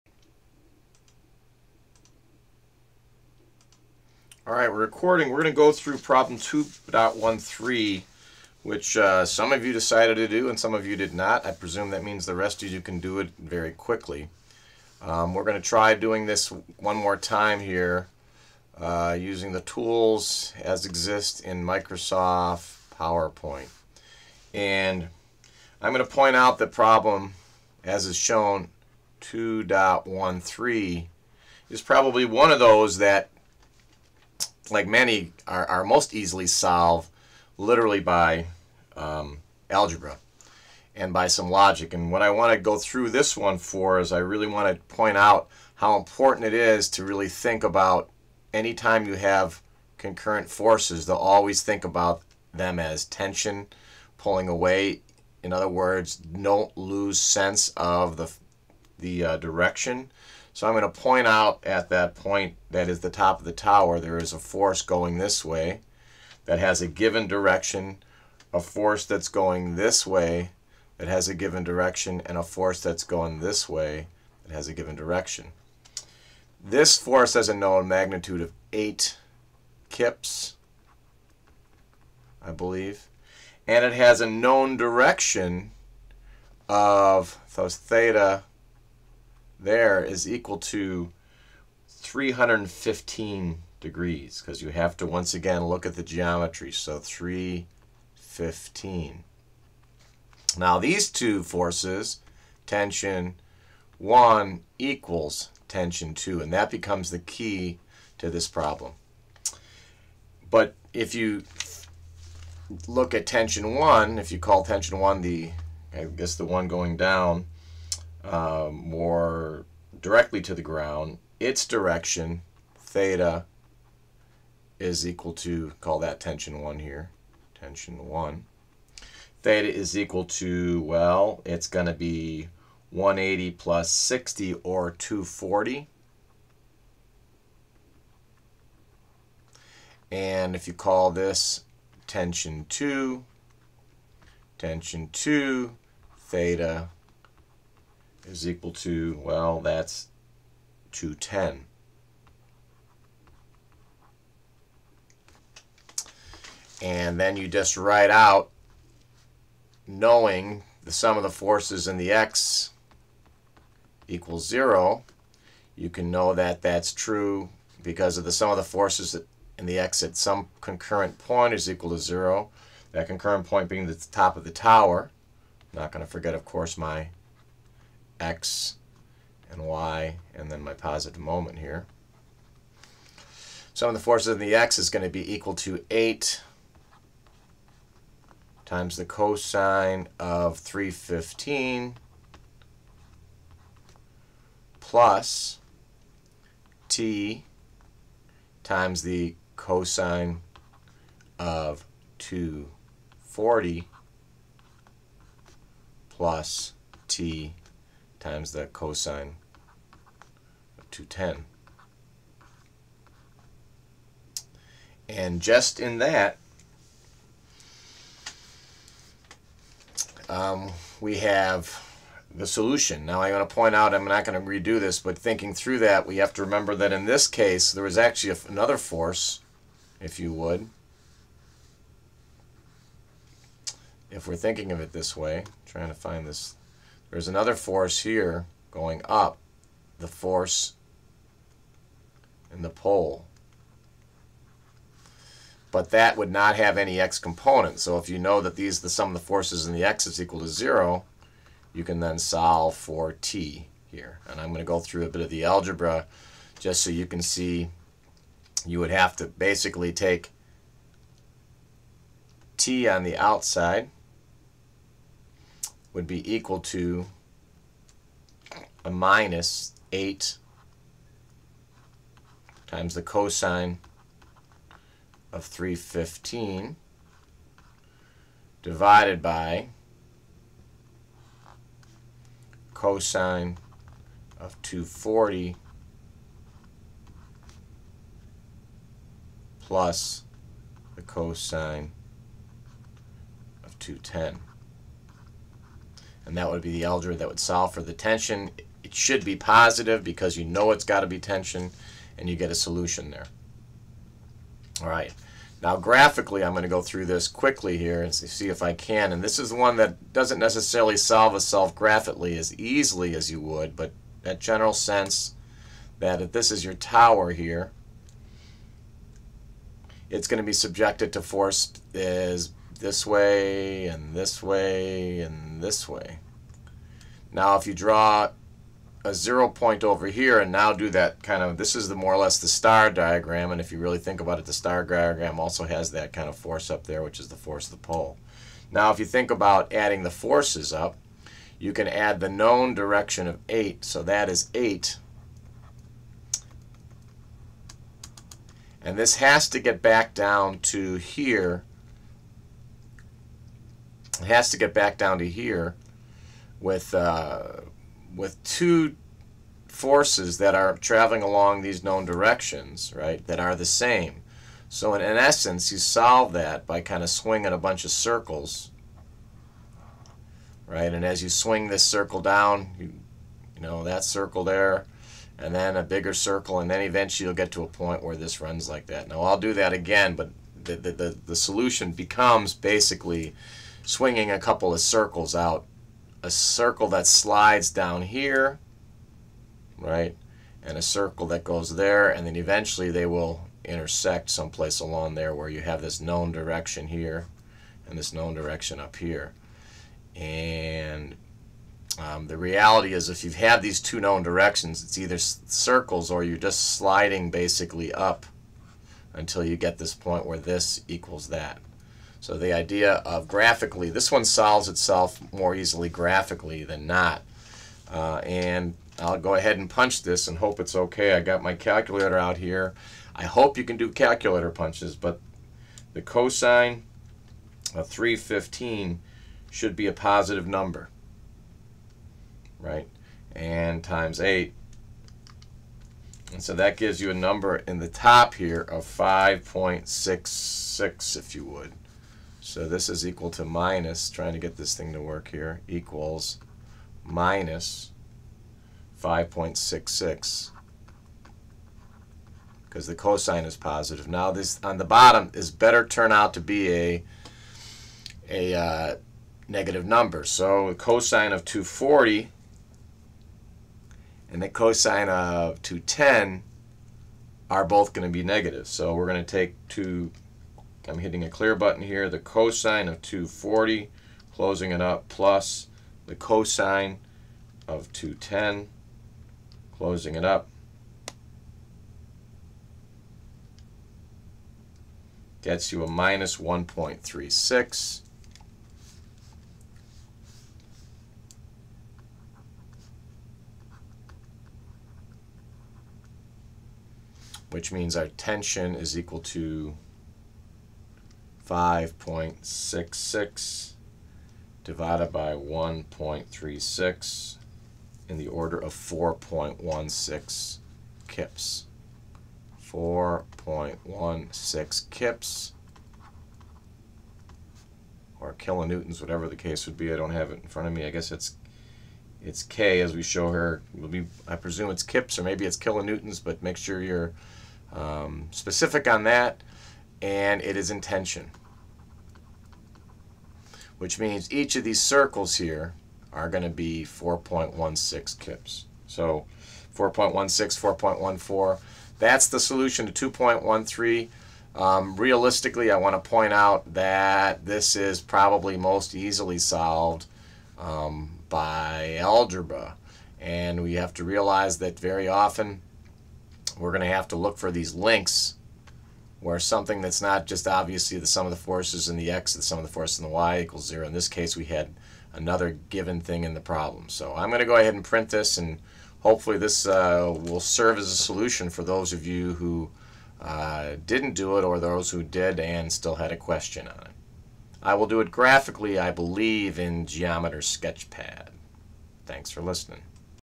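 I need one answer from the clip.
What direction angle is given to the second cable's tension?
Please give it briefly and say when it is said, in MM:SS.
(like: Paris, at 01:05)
210, at 02:29.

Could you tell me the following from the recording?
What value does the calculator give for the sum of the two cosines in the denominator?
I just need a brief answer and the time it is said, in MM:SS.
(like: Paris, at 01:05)
-1.36, at 08:05.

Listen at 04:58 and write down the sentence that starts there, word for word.
It should be positive because you know it's got to be tension, and you get a solution there.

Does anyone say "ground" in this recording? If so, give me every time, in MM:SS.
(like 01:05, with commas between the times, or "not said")
02:00.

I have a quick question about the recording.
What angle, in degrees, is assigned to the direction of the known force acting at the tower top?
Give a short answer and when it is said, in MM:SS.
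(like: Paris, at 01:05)
315, at 01:31.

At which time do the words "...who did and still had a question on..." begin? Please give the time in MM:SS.
09:34.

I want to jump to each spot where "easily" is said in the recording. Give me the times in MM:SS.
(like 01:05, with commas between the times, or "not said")
00:36, 05:12, 06:55, 09:08.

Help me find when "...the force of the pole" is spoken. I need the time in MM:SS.
05:37.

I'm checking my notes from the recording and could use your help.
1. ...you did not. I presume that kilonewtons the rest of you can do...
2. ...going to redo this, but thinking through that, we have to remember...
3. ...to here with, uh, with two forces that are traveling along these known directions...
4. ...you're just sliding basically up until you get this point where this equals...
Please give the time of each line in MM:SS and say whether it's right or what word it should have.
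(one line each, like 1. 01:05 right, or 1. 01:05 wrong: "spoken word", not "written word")
1. 00:10 wrong: "means", not "kilonewtons"
2. 03:44 right
3. 05:55 right
4. 06:46 right.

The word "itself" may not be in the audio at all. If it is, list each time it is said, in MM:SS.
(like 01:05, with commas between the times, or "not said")
05:11, 06:54.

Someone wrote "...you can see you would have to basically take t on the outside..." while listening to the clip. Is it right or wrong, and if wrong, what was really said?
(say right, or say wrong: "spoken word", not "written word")
right.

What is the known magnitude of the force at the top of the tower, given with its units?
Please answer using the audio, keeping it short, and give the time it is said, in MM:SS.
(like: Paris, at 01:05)
8 kips, at 01:18.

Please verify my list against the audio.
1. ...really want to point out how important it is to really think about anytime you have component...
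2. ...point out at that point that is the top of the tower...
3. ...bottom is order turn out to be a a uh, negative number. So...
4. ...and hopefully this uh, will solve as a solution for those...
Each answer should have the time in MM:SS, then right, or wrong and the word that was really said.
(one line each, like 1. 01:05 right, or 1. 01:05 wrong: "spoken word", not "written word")
1. 00:44 wrong: "concurrent", not "component"
2. 01:01 right
3. 07:34 wrong: "better", not "order"
4. 09:28 wrong: "serve", not "solve".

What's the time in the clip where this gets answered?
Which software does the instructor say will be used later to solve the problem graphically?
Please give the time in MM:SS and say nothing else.
09:39.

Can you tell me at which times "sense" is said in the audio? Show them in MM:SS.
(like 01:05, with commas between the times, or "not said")
00:57, 05:14.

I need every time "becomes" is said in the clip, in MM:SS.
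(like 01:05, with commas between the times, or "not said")
01:46, 06:21.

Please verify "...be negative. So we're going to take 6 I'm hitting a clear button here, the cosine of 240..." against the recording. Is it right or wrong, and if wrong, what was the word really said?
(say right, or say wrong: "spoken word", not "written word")
wrong: "2", not "6".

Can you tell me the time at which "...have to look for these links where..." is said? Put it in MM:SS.
09:16.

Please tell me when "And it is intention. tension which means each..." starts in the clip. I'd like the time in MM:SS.
08:50.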